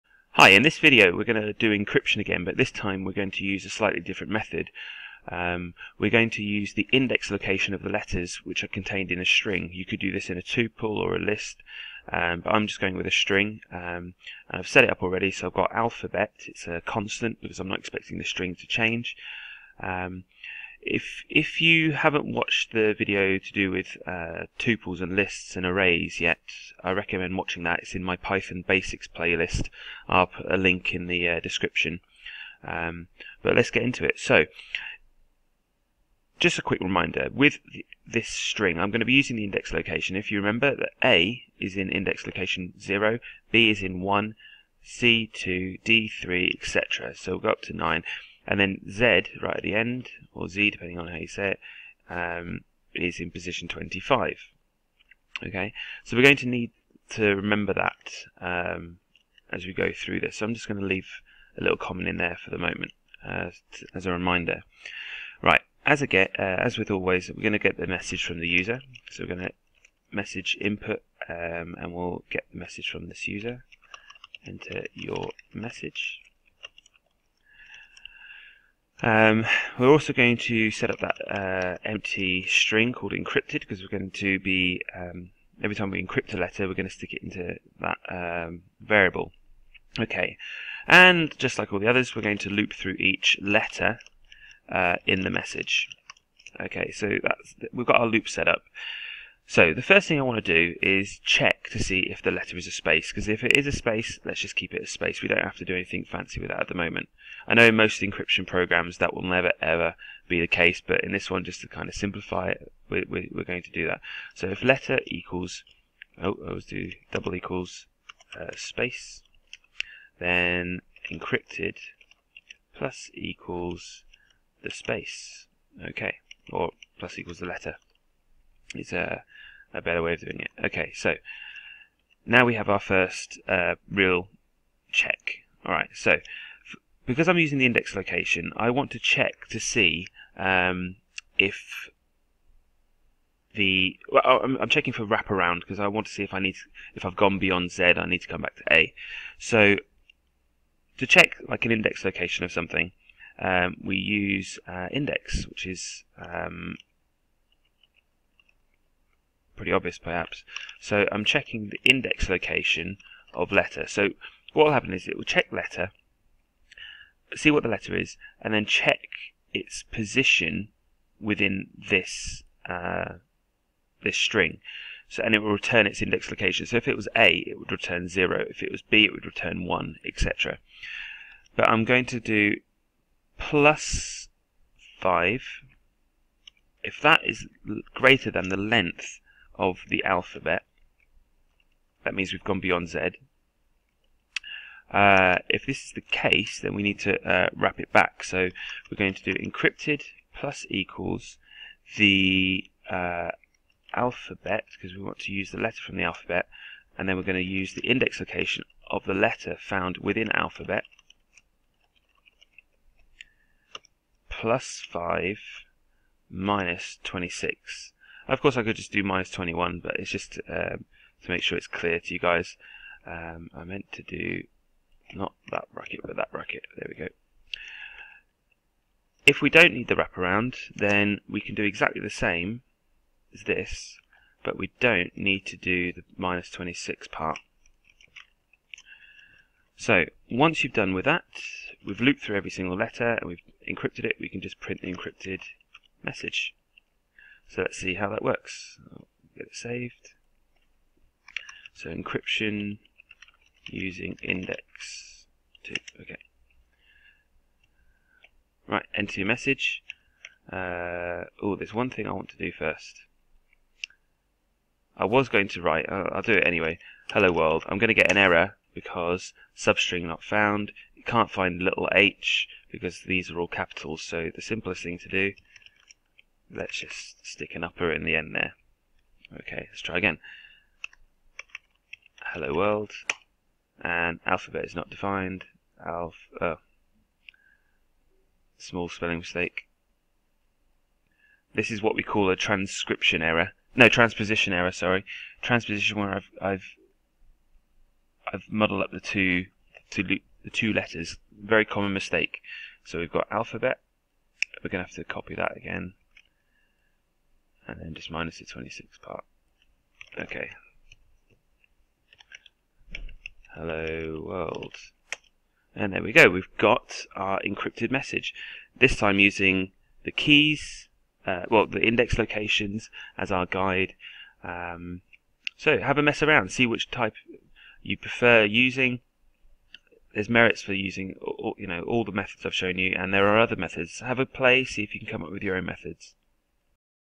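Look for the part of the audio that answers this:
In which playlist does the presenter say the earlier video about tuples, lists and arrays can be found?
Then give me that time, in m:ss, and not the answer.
0:28.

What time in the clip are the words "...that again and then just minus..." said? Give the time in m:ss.
5:05.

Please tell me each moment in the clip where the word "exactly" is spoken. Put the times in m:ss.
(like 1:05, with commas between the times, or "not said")
3:51.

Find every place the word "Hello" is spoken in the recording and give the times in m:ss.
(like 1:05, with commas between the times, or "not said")
4:27, 4:42, 5:13.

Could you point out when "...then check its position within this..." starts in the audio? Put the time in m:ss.
2:48.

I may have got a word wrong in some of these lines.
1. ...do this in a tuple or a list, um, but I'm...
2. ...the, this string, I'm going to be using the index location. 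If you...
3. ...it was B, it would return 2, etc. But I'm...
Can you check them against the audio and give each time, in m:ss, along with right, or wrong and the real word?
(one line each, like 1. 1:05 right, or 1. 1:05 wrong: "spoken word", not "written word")
1. 0:09 right
2. 0:37 right
3. 2:58 wrong: "1", not "2".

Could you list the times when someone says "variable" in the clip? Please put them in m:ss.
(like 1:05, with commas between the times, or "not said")
1:28.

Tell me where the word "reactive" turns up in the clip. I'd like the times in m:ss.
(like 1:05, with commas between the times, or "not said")
not said.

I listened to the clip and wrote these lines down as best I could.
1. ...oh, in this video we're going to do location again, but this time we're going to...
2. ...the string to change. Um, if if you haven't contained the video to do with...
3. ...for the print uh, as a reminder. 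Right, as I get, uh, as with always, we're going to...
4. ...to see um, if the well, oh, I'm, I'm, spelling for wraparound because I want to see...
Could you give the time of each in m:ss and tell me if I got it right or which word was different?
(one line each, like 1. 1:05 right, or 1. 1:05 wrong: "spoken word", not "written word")
1. 0:00 wrong: "encryption", not "location"
2. 0:18 wrong: "watched", not "contained"
3. 1:02 wrong: "moment", not "print"
4. 2:19 wrong: "checking", not "spelling".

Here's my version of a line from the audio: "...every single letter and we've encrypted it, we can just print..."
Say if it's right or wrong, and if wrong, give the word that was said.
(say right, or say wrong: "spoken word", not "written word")
right.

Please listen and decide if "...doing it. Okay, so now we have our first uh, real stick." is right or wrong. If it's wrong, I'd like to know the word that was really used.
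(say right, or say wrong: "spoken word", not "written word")
wrong: "check", not "stick".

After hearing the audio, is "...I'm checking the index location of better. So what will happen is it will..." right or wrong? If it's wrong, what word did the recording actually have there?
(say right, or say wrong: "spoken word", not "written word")
wrong: "letter", not "better".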